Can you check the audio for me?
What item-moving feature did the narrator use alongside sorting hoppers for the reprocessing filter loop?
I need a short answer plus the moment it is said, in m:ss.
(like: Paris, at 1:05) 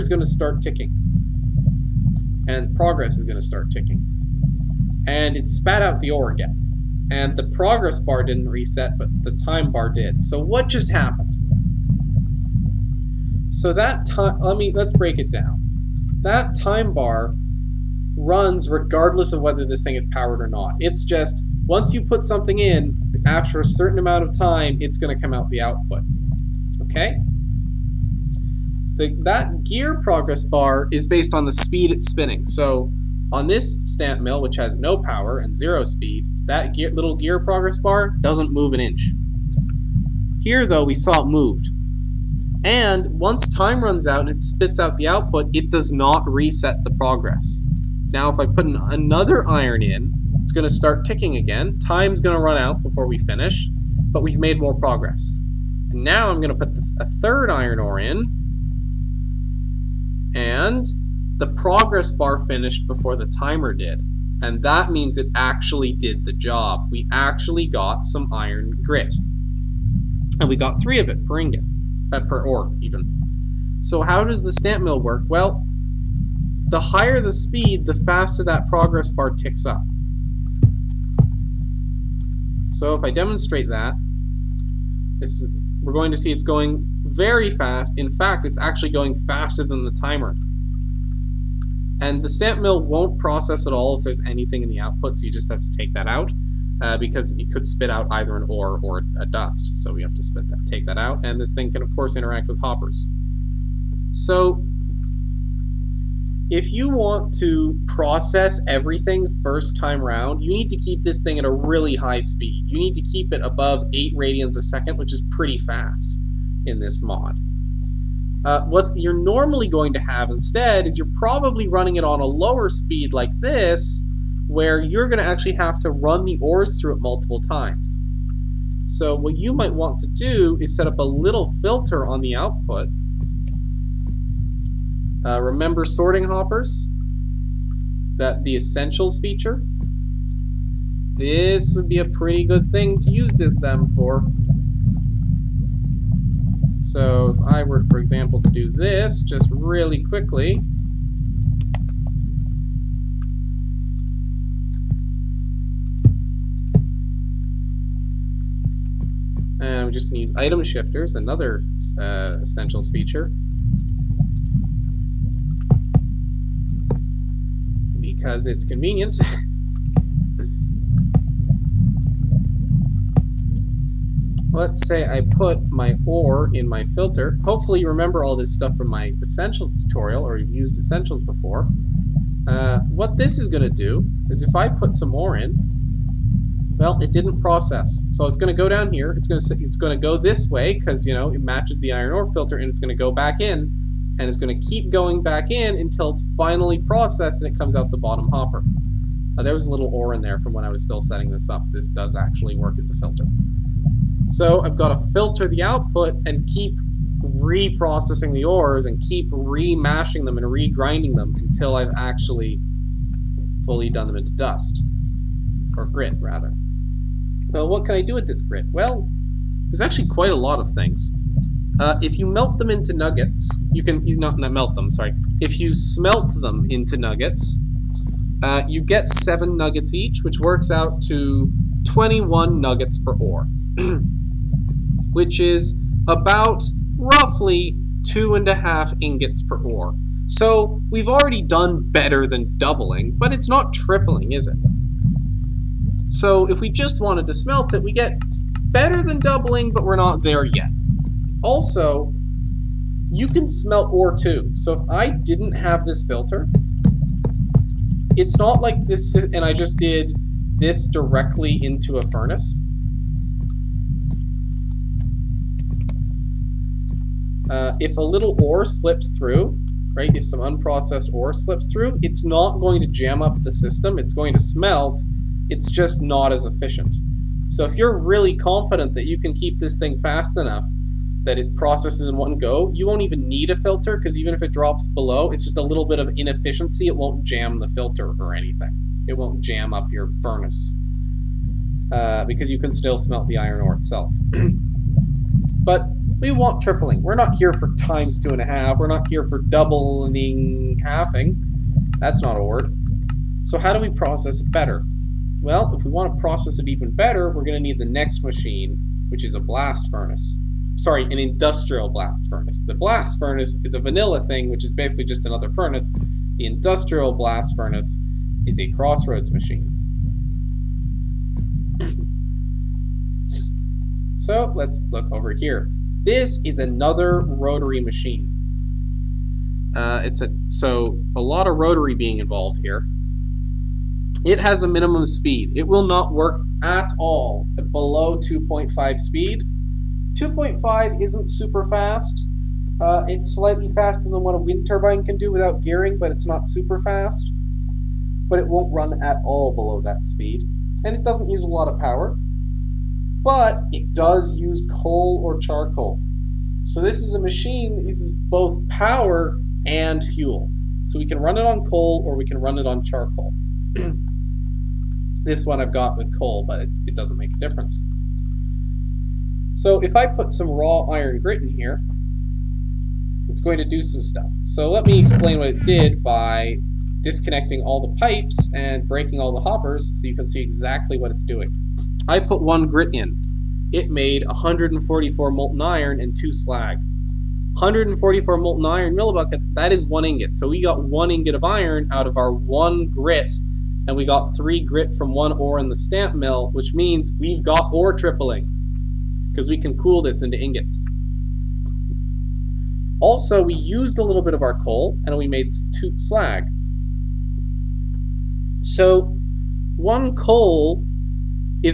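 Item shifters, at 2:40.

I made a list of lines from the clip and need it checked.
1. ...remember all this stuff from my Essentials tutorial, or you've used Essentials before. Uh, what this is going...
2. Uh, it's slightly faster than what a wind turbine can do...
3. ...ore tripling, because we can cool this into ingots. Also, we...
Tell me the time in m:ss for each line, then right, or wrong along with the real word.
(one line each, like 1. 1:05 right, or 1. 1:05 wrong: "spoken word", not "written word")
1. 2:57 right
2. 5:42 right
3. 6:37 right.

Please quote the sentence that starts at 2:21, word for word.
This would be a pretty good thing to use them for.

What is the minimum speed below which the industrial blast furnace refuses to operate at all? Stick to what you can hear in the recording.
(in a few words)
2.5.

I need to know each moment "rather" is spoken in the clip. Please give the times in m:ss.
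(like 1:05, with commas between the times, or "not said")
3:36.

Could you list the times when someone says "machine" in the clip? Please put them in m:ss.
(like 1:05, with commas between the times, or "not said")
5:08, 5:19, 5:27, 5:57.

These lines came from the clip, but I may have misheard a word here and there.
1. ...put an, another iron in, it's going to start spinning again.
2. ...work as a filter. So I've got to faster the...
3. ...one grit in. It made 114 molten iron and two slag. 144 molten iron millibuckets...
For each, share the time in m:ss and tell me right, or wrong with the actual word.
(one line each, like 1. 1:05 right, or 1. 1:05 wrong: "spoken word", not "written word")
1. 0:48 wrong: "ticking", not "spinning"
2. 3:22 wrong: "filter", not "faster"
3. 6:22 wrong: "144", not "114".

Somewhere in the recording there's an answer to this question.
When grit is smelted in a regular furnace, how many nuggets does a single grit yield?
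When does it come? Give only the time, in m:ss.
3:49.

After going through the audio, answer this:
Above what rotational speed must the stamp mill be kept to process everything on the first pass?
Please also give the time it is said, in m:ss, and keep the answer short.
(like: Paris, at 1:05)
8 radians a second, at 1:53.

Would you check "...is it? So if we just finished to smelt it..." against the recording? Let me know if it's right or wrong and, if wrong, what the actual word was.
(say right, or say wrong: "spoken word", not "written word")
wrong: "wanted", not "finished".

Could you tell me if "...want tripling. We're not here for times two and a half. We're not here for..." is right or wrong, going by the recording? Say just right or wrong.
right.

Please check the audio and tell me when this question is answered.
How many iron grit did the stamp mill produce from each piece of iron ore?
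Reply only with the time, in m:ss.
1:10.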